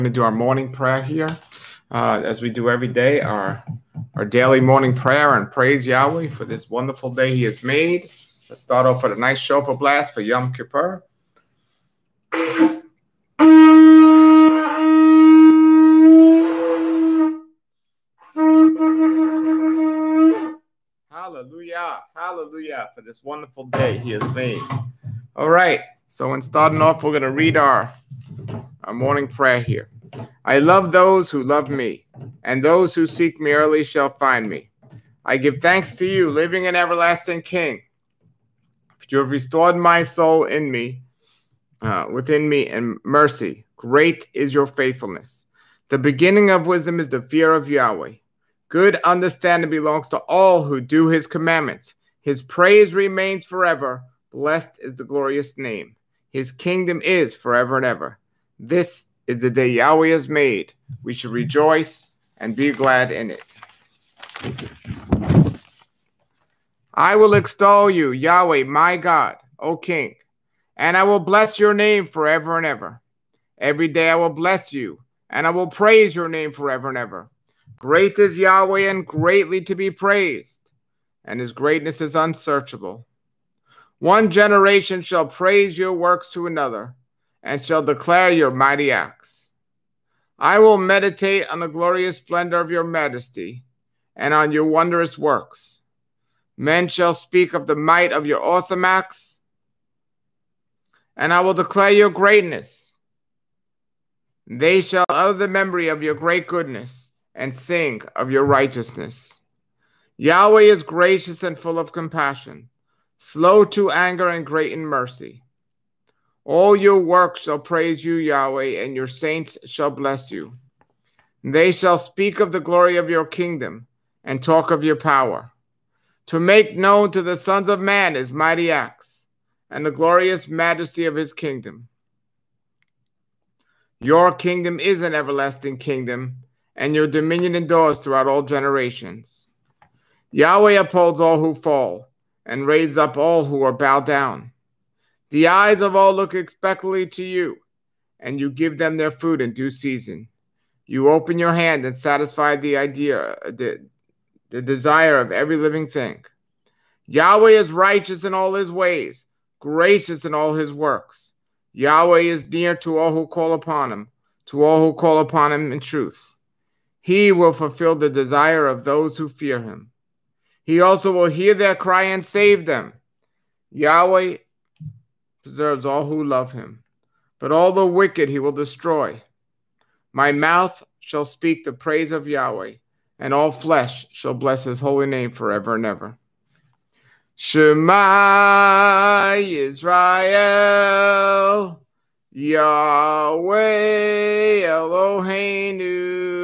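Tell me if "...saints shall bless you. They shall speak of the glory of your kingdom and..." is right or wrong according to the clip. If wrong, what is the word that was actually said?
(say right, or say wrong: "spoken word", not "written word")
right.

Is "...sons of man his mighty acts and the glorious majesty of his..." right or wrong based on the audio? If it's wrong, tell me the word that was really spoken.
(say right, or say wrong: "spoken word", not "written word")
right.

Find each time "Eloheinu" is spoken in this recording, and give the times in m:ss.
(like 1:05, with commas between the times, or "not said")
3:14.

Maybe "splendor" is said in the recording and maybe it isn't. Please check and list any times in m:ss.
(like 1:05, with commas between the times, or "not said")
1:32.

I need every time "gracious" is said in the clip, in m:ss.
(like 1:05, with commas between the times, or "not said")
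1:50, 2:39.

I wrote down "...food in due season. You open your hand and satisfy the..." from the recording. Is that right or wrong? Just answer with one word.
right.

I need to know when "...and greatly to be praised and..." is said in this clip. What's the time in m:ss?
1:18.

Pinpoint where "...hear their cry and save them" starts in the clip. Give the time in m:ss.
2:51.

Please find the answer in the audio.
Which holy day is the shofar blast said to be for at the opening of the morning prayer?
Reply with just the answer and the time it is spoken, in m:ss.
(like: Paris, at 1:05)
Yom Kippur, at 0:10.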